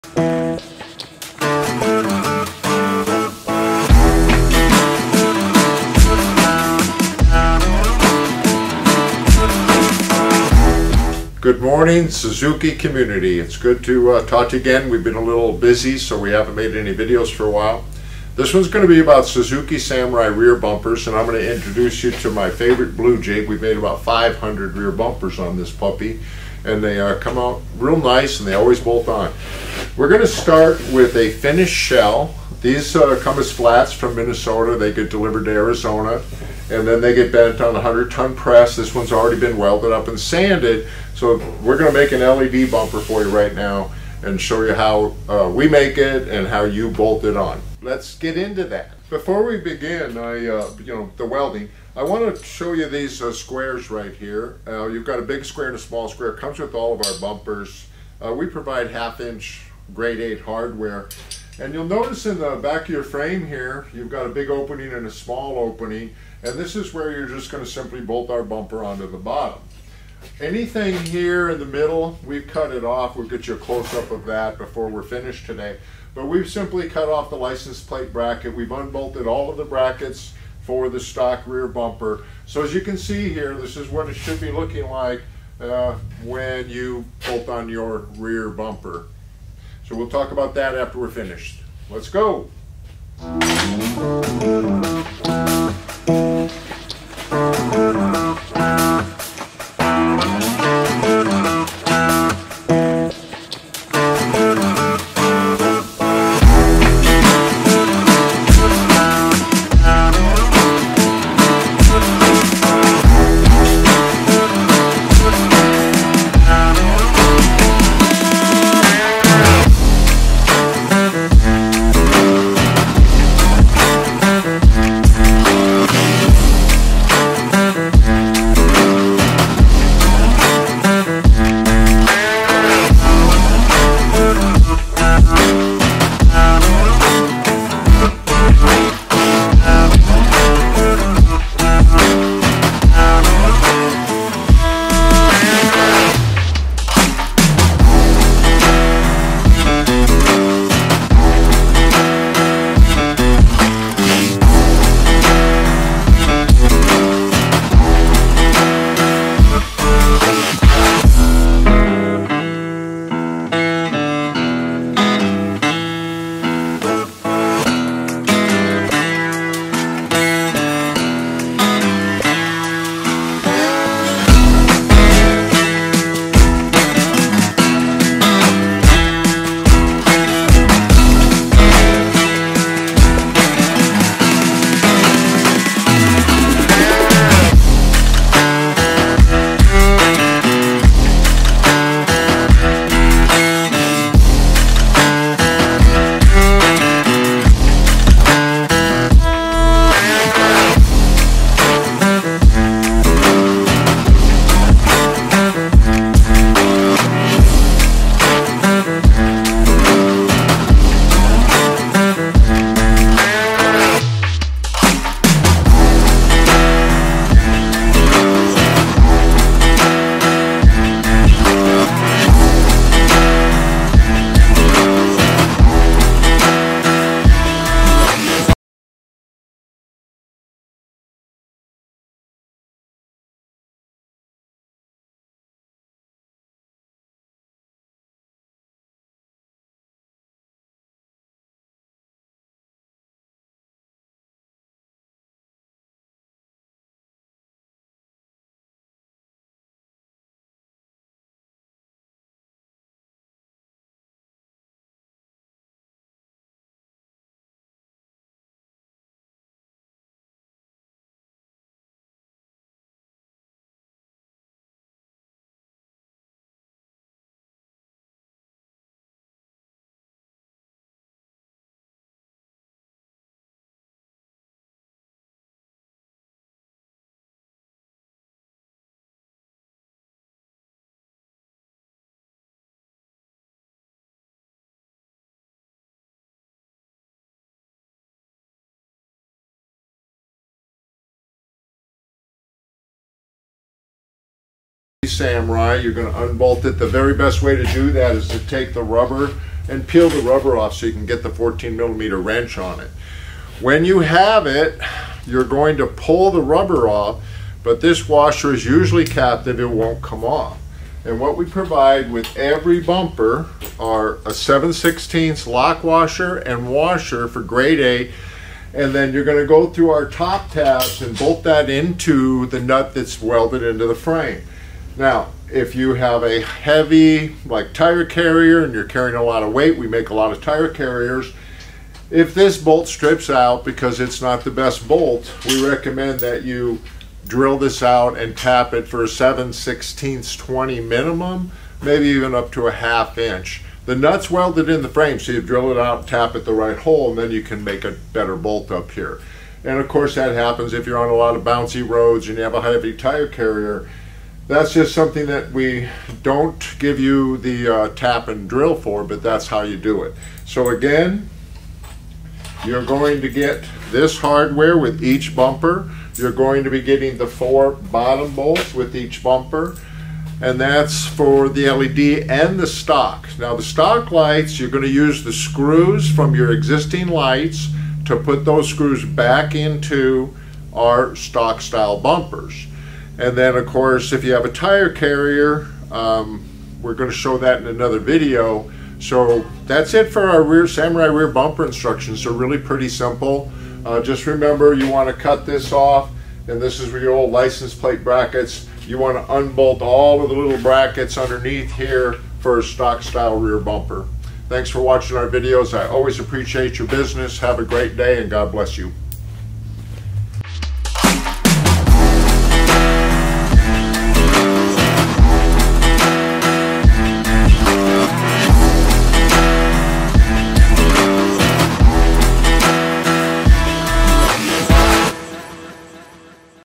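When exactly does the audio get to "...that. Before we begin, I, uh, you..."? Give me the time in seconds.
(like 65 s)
48 s.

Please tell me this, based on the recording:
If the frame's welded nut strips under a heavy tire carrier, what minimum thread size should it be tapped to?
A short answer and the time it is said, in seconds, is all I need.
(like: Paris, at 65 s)
7/16-20, at 339 s.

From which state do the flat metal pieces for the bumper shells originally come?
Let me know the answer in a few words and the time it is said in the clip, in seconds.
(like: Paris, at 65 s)
Minnesota, at 34 s.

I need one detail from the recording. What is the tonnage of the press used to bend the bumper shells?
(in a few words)
100 ton.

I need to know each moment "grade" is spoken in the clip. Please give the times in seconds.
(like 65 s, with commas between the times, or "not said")
59 s, 317 s.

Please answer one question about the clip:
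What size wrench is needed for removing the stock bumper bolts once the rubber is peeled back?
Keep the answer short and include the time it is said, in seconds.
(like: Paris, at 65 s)
14 millimeter, at 301 s.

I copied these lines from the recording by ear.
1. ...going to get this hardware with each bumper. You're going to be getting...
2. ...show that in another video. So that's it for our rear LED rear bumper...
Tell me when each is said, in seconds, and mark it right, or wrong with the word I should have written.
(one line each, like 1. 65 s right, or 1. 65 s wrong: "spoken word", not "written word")
1. 362 s right
2. 387 s wrong: "Samurai", not "LED".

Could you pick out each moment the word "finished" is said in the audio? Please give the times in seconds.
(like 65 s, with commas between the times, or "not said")
31 s, 75 s, 91 s.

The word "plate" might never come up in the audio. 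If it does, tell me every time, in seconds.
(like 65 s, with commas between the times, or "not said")
77 s, 397 s.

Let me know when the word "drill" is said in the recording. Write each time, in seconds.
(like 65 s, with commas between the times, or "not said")
337 s, 345 s, 358 s.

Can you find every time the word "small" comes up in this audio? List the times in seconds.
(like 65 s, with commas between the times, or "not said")
55 s, 65 s.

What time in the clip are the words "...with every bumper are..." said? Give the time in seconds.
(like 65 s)
312 s.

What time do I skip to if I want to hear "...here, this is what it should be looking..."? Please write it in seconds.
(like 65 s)
83 s.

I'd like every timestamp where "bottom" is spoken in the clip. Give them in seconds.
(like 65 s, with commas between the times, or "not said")
69 s, 367 s.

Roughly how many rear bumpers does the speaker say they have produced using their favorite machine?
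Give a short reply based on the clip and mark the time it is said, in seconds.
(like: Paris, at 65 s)
500, at 23 s.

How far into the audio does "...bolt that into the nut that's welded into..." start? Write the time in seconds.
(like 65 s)
321 s.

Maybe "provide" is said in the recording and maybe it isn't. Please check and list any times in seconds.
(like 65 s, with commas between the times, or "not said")
58 s, 311 s.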